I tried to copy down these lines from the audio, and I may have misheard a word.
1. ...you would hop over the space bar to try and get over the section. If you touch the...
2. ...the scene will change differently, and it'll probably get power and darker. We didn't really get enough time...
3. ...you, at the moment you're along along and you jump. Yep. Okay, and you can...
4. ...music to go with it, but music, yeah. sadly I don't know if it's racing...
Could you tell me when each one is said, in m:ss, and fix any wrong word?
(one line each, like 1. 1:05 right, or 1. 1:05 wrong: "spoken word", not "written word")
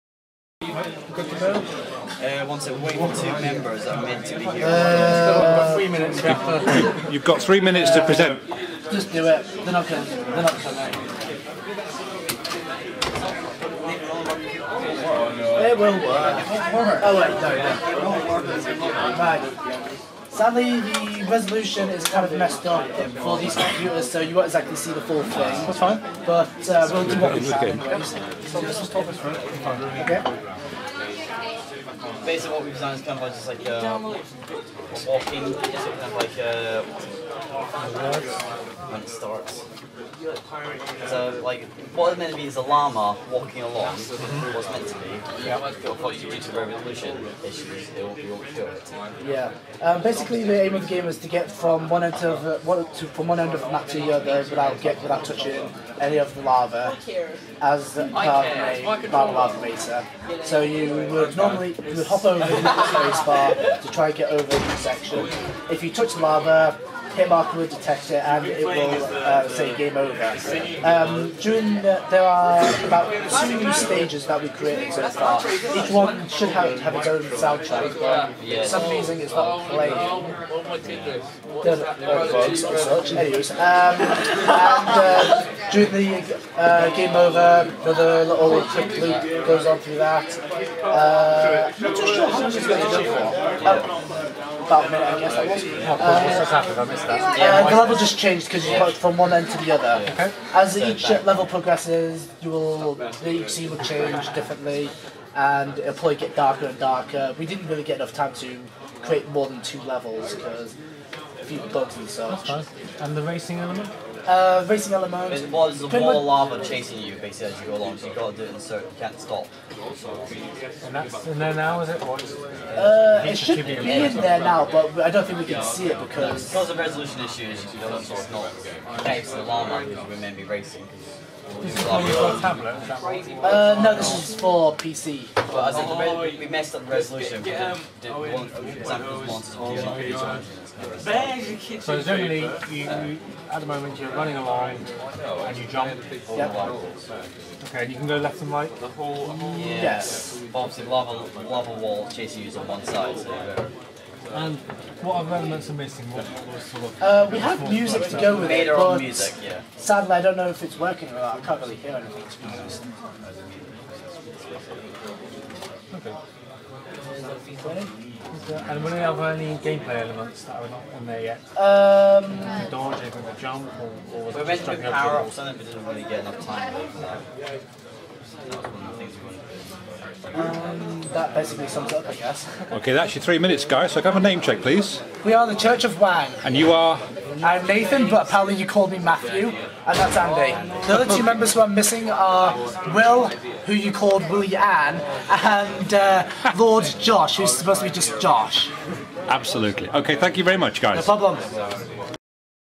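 1. 1:01 right
2. 1:42 wrong: "darker", not "power"
3. 2:22 wrong: "running", not "along"
4. 2:37 wrong: "working", not "racing".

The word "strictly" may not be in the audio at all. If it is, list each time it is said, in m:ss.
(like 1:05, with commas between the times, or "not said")
not said.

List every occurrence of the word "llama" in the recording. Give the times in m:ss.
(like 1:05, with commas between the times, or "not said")
0:42, 2:09.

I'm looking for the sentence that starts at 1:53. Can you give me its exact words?
And the racing element uh, racing element.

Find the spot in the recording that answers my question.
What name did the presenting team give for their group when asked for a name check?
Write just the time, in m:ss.
3:05.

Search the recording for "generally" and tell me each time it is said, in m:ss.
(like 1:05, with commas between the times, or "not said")
2:22.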